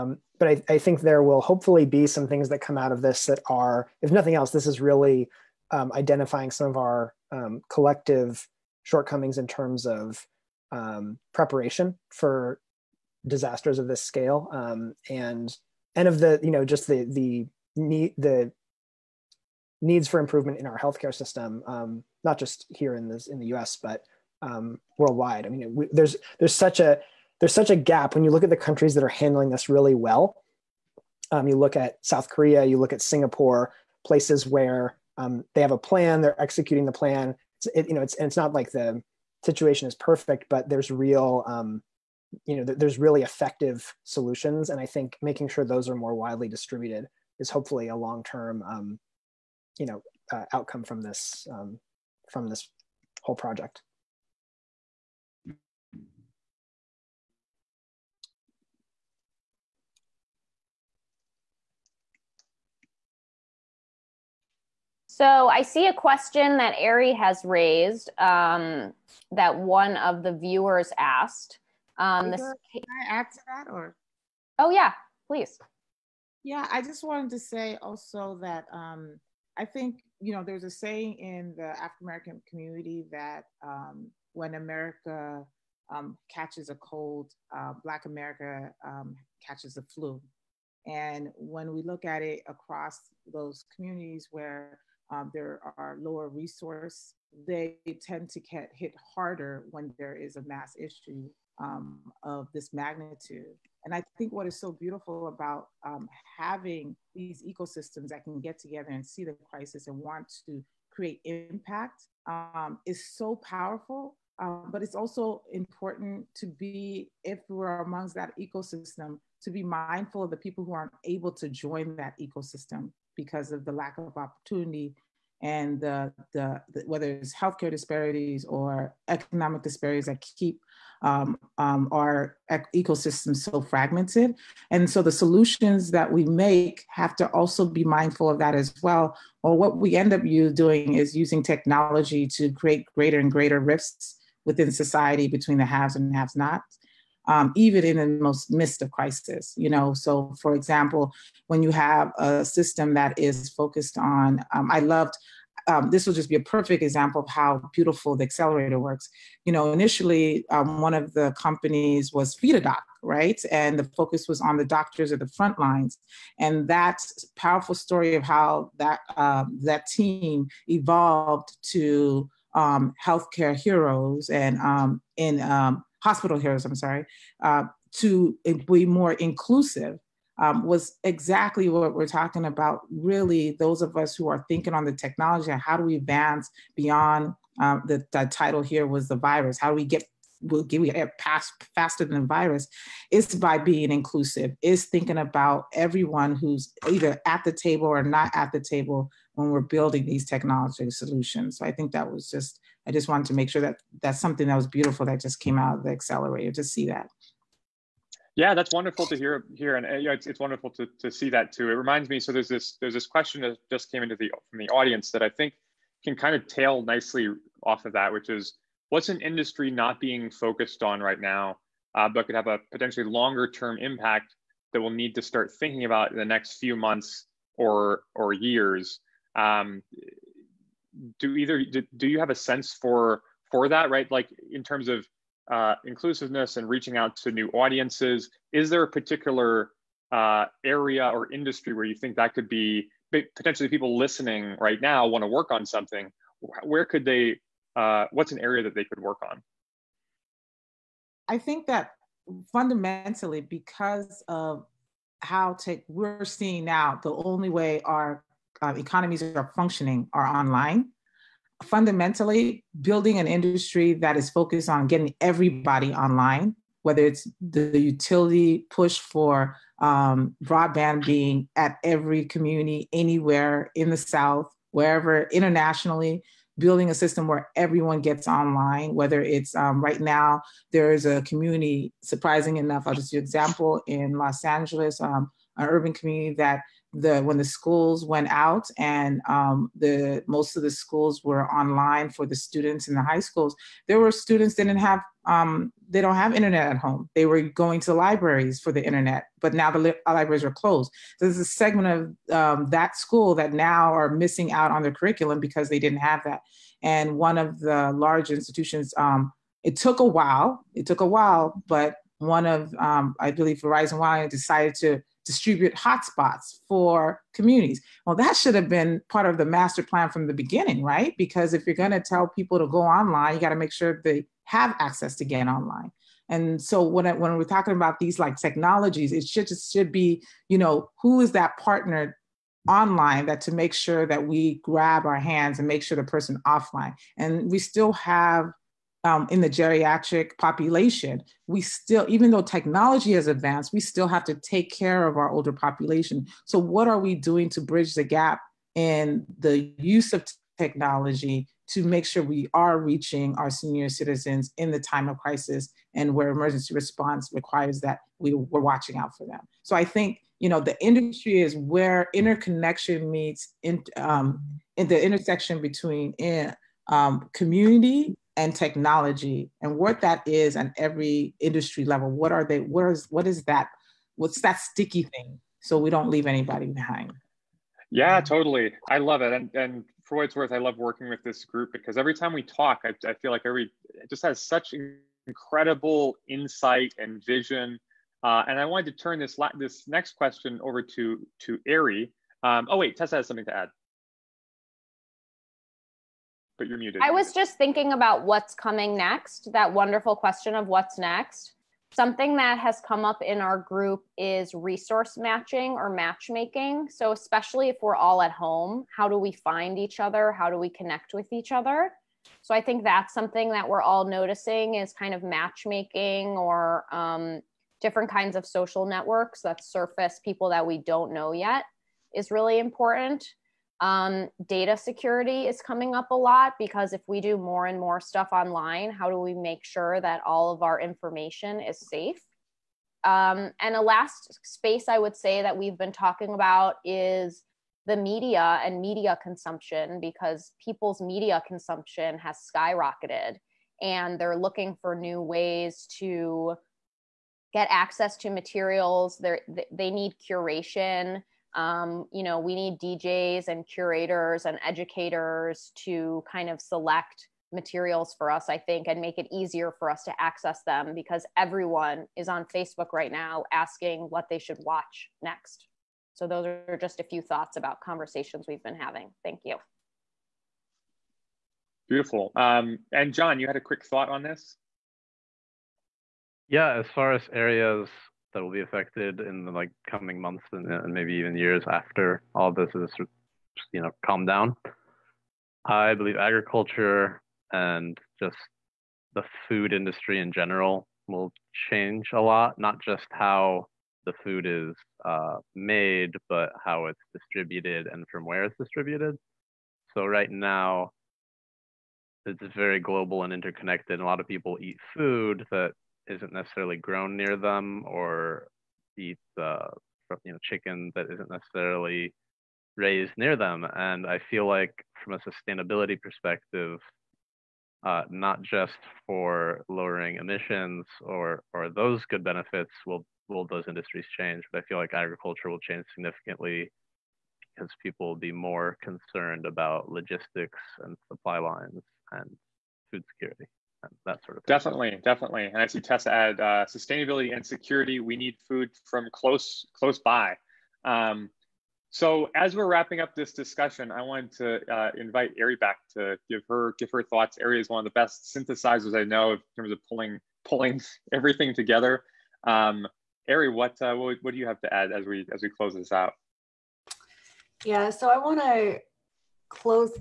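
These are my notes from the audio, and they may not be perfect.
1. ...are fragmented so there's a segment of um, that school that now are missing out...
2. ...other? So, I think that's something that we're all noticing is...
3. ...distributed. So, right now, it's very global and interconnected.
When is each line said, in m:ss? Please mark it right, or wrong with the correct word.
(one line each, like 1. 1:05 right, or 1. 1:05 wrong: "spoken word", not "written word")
1. 5:00 wrong: "closed", not "fragmented"
2. 6:51 right
3. 8:18 right.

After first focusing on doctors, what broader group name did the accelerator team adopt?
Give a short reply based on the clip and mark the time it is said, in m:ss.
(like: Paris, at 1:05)
hospital heroes, at 2:56.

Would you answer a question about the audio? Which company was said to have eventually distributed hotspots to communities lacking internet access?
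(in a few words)
Verizon Wireless.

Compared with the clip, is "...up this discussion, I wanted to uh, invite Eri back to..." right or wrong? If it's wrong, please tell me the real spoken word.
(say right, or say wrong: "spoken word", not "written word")
right.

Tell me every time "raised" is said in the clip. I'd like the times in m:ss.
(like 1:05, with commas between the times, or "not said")
1:07, 8:32.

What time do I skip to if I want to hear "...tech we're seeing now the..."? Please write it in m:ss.
4:15.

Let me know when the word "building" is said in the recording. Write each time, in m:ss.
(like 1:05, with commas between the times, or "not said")
3:19, 4:22, 4:36.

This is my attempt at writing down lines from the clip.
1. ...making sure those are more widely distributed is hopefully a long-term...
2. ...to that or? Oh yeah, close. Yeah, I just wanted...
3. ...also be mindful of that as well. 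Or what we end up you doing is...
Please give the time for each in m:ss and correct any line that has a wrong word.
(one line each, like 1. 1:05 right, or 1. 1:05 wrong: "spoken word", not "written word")
1. 0:45 right
2. 1:13 wrong: "please", not "close"
3. 2:17 right.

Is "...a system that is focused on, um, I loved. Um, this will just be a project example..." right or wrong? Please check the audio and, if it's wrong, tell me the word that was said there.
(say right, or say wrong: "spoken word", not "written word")
wrong: "perfect", not "project".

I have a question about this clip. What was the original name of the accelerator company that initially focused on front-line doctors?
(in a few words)
FedaDoc.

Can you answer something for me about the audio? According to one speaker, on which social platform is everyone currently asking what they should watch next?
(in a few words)
Facebook.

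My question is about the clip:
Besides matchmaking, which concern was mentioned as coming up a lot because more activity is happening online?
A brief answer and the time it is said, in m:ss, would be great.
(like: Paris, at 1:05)
data security, at 7:04.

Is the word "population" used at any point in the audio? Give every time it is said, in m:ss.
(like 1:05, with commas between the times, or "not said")
5:40, 5:45.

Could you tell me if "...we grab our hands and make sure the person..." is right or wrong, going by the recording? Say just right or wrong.
right.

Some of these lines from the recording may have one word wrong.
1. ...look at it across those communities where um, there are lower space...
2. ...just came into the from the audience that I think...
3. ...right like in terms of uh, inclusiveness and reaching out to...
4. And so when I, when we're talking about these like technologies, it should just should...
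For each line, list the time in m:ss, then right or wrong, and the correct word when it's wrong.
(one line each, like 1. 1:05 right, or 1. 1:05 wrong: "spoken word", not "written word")
1. 1:31 wrong: "resource", not "space"
2. 3:33 right
3. 3:53 right
4. 5:26 right.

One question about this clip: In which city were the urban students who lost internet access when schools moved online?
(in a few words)
Los Angeles.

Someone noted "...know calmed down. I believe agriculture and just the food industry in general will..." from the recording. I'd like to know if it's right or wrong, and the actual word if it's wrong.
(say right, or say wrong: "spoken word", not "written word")
right.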